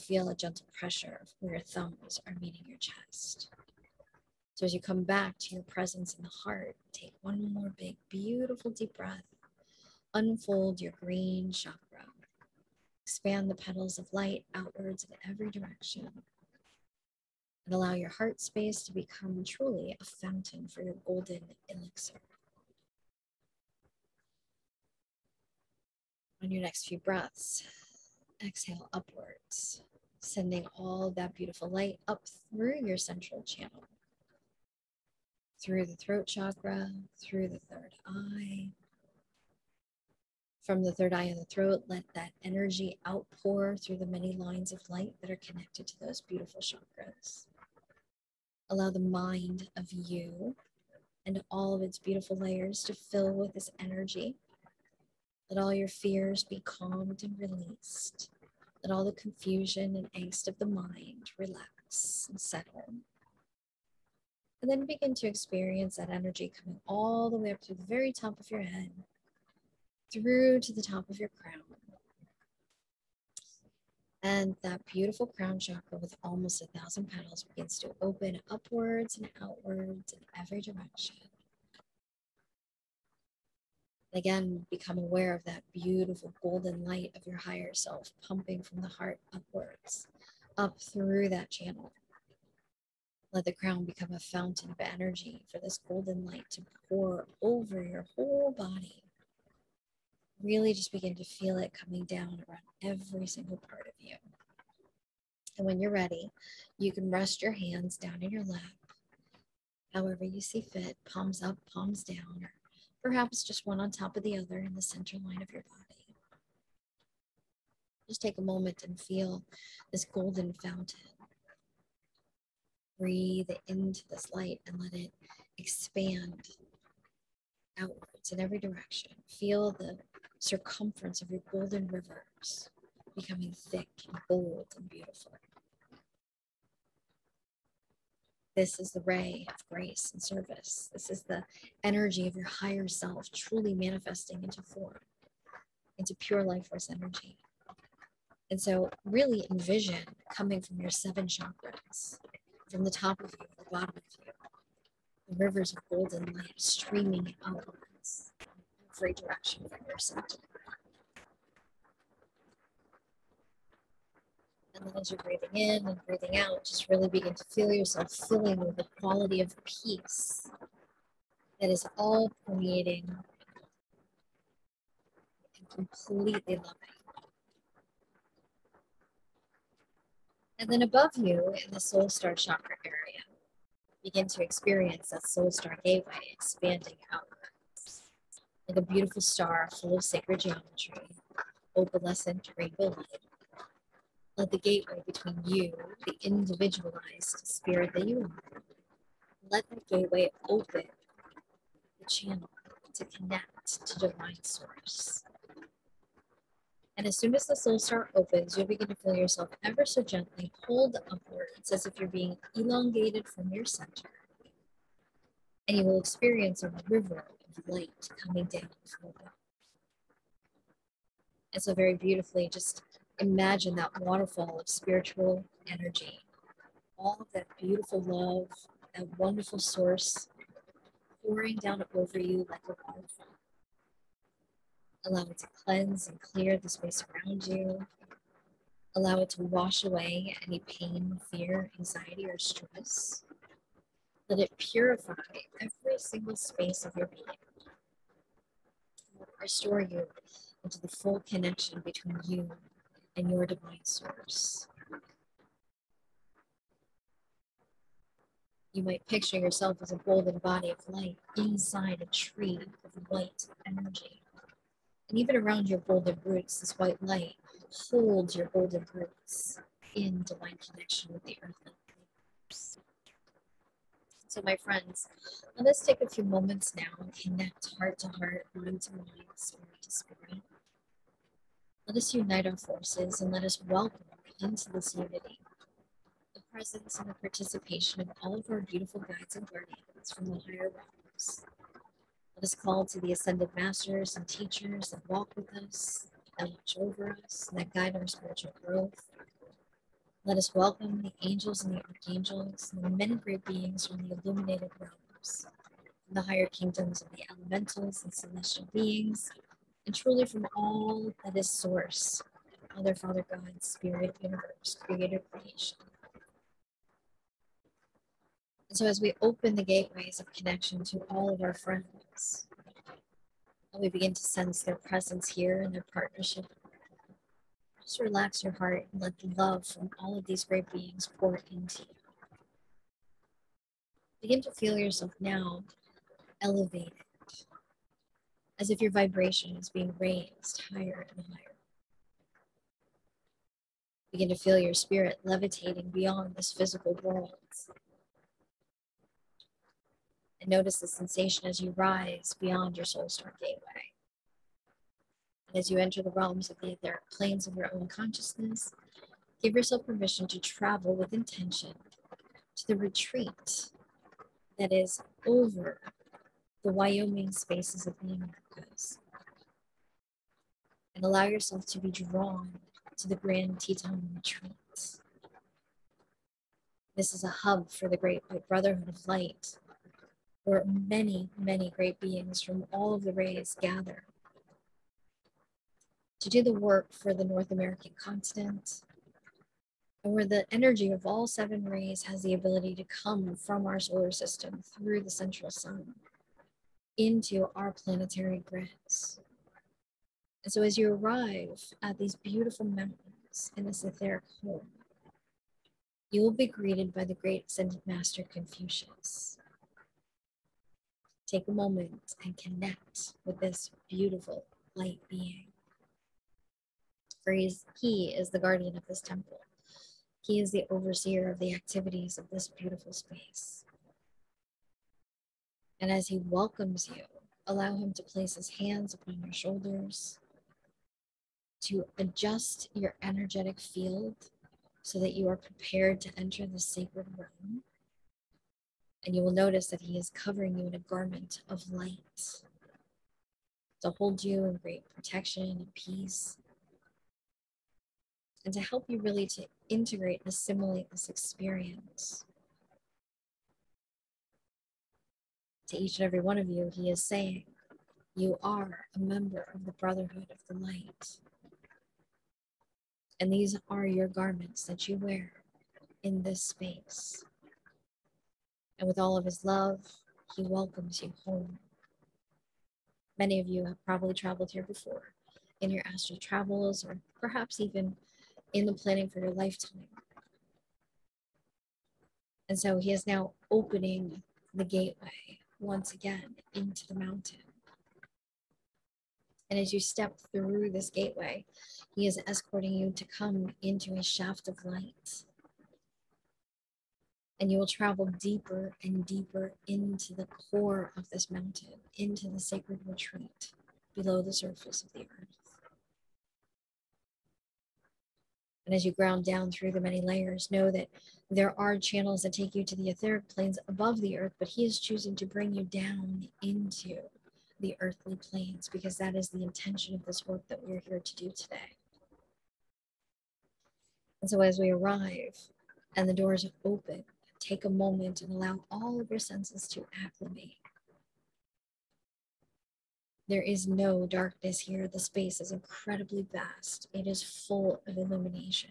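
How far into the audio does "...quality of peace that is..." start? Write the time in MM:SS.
02:48.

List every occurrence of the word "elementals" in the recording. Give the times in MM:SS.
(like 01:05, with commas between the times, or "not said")
05:07.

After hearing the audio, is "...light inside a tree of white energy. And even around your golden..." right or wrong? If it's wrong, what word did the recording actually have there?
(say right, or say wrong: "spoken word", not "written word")
right.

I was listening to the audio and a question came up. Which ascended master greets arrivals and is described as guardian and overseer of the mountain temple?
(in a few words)
Confucius.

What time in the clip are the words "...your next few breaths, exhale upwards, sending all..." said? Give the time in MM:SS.
00:26.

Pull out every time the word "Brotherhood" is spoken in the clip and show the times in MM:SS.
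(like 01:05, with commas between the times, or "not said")
06:18, 07:39.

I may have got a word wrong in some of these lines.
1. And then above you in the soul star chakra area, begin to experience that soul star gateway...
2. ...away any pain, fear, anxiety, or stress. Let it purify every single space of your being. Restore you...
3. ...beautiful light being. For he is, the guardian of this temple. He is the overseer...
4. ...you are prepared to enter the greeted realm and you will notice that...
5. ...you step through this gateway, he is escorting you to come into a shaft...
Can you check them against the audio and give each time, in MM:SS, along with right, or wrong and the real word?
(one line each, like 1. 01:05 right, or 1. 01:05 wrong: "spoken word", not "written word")
1. 03:00 right
2. 03:59 right
3. 06:53 right
4. 07:15 wrong: "sacred", not "greeted"
5. 08:09 right.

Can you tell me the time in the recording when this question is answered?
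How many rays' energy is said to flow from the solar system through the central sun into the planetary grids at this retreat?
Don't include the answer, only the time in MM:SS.
06:31.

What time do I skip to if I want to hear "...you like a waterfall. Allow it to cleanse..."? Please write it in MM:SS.
03:52.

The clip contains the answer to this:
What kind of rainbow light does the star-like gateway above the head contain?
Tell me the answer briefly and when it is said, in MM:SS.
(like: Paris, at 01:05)
opalescent, at 03:11.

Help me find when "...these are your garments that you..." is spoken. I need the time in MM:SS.
07:43.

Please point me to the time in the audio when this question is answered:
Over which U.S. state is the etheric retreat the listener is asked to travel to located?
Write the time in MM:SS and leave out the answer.
06:06.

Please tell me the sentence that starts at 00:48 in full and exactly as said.
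Allow the mind of you and all of its beautiful layers to fill with this energy.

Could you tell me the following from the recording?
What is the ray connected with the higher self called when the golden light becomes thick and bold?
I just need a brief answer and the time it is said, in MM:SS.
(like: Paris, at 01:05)
ray of grace and service, at 02:18.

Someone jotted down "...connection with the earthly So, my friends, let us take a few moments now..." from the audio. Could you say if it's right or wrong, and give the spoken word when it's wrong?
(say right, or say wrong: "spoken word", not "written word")
right.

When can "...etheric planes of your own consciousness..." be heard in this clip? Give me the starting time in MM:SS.
05:56.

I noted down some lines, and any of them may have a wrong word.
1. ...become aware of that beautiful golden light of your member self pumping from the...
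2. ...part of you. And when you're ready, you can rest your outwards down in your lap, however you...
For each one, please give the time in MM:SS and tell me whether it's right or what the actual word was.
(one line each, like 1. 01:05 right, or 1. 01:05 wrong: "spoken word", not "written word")
1. 01:24 wrong: "higher", not "member"
2. 01:43 wrong: "hands", not "outwards".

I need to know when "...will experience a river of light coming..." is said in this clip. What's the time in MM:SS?
03:35.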